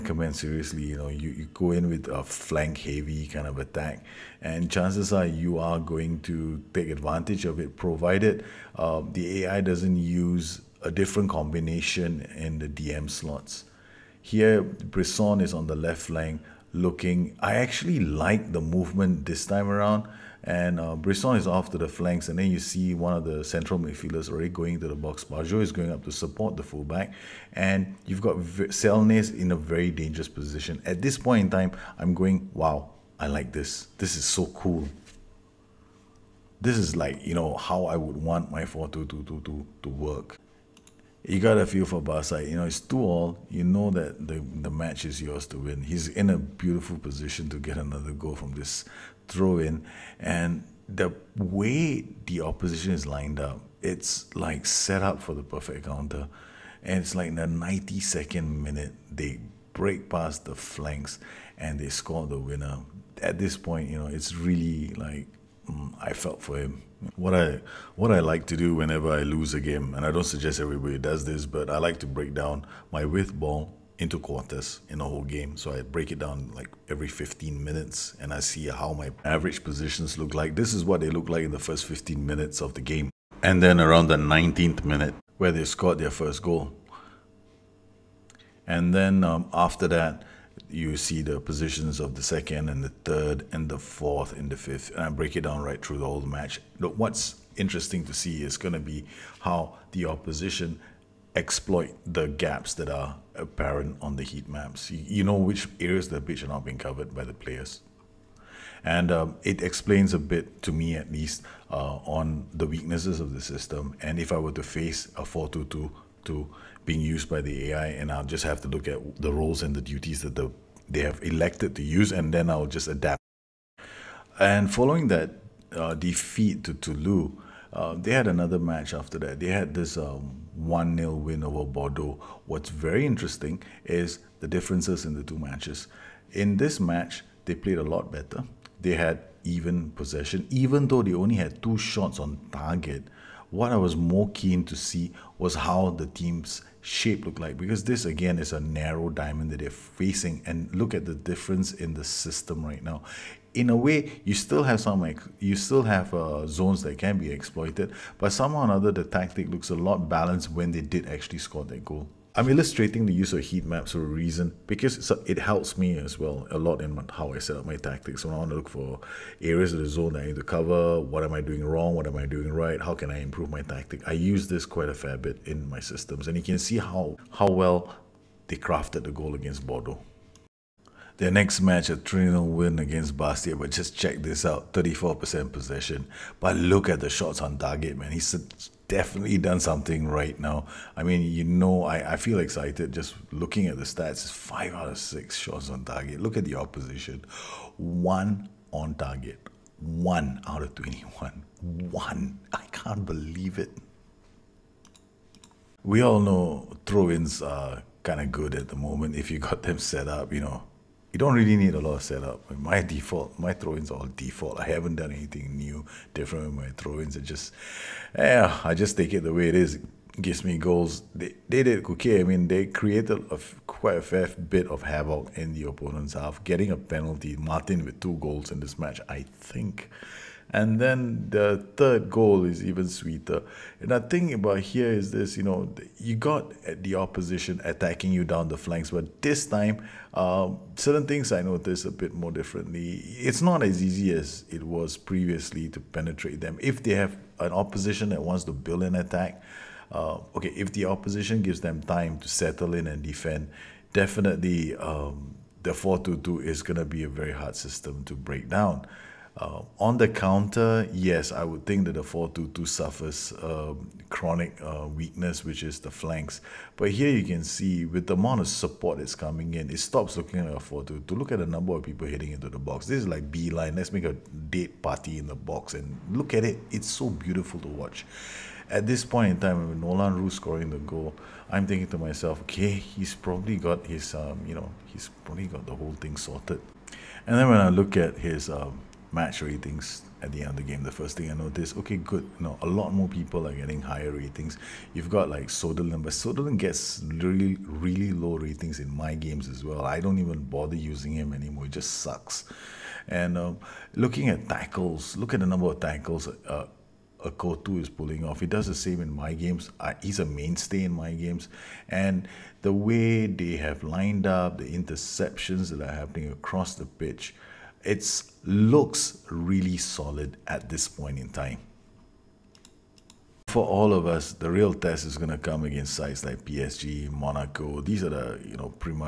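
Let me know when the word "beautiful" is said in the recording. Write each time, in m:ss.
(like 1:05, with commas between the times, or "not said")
0:46, 4:37.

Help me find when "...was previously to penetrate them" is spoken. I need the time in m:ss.
4:04.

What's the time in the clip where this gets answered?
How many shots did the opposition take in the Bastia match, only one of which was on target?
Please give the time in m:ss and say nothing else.
3:20.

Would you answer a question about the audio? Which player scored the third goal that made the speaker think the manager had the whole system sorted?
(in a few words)
Nolan Roux.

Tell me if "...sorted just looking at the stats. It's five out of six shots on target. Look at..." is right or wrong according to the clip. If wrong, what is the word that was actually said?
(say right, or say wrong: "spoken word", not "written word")
wrong: "excited", not "sorted".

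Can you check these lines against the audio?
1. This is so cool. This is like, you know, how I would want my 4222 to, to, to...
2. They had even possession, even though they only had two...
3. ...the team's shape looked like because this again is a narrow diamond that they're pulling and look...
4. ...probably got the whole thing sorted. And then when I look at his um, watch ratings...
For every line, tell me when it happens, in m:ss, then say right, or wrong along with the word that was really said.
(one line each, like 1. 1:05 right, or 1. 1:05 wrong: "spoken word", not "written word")
1. 0:33 right
2. 2:18 right
3. 2:25 wrong: "facing", not "pulling"
4. 4:45 wrong: "match", not "watch".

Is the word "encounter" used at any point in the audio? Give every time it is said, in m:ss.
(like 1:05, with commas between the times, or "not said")
not said.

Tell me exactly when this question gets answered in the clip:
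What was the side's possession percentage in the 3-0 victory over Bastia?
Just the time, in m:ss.
3:04.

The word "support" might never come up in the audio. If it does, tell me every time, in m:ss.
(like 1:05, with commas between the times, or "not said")
0:26, 4:28.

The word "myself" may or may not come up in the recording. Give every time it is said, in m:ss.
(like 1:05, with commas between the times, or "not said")
4:41.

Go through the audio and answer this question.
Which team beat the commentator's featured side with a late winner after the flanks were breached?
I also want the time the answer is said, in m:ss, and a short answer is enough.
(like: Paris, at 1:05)
Toulouse, at 2:06.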